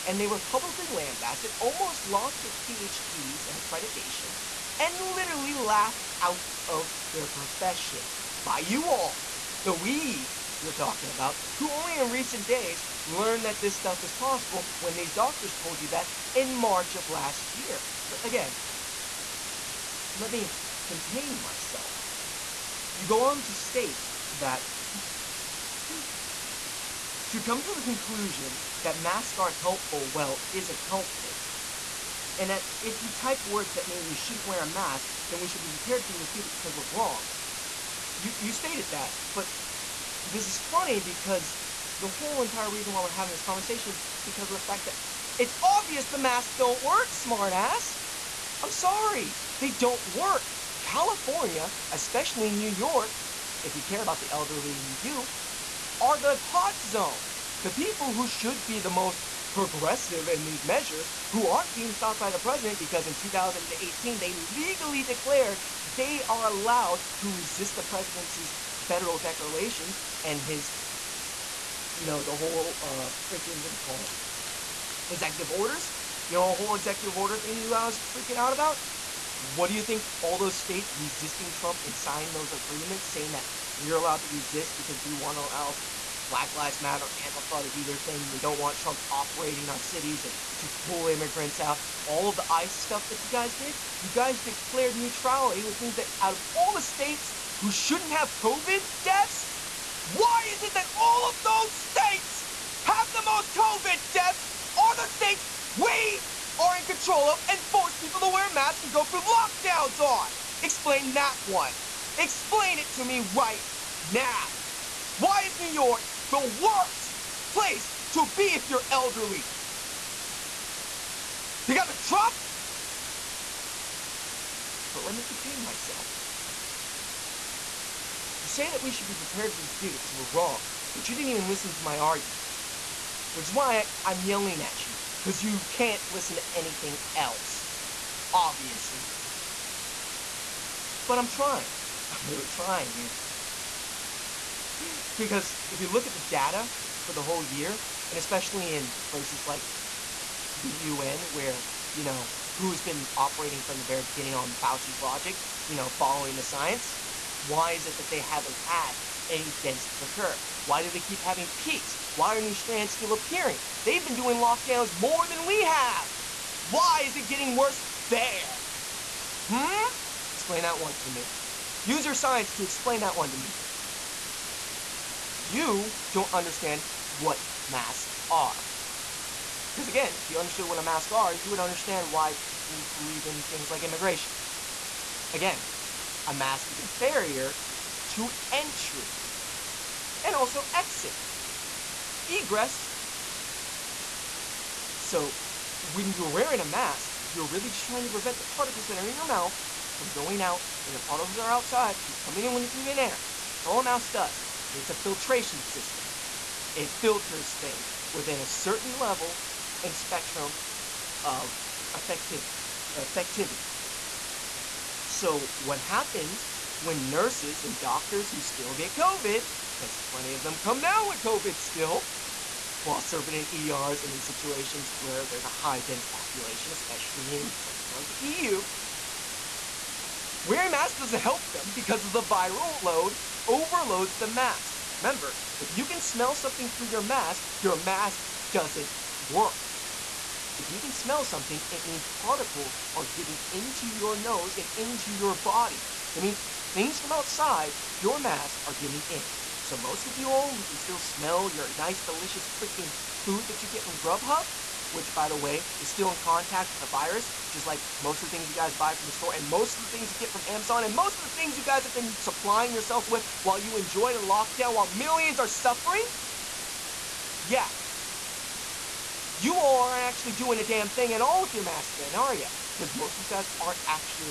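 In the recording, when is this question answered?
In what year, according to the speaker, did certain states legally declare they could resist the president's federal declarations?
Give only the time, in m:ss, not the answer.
1:03.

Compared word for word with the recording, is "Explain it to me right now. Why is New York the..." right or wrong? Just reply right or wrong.
right.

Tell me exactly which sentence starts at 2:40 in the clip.
Why do they keep having peaks?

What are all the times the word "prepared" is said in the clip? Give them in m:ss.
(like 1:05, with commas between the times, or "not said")
0:35, 2:09.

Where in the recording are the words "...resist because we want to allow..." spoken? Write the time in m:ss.
1:24.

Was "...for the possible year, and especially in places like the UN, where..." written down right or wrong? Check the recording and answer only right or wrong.
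wrong.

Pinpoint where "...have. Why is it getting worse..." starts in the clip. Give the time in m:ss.
2:45.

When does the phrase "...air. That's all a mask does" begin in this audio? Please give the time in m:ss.
3:22.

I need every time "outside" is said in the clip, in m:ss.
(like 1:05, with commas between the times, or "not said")
3:21, 4:07.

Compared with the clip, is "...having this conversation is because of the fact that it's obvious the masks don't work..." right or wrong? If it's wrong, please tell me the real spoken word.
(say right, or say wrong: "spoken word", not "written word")
right.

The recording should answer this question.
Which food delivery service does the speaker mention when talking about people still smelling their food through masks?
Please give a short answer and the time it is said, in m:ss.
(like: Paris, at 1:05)
Grubhub, at 4:13.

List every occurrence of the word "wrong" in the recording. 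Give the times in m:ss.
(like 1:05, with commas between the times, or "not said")
0:36, 2:10.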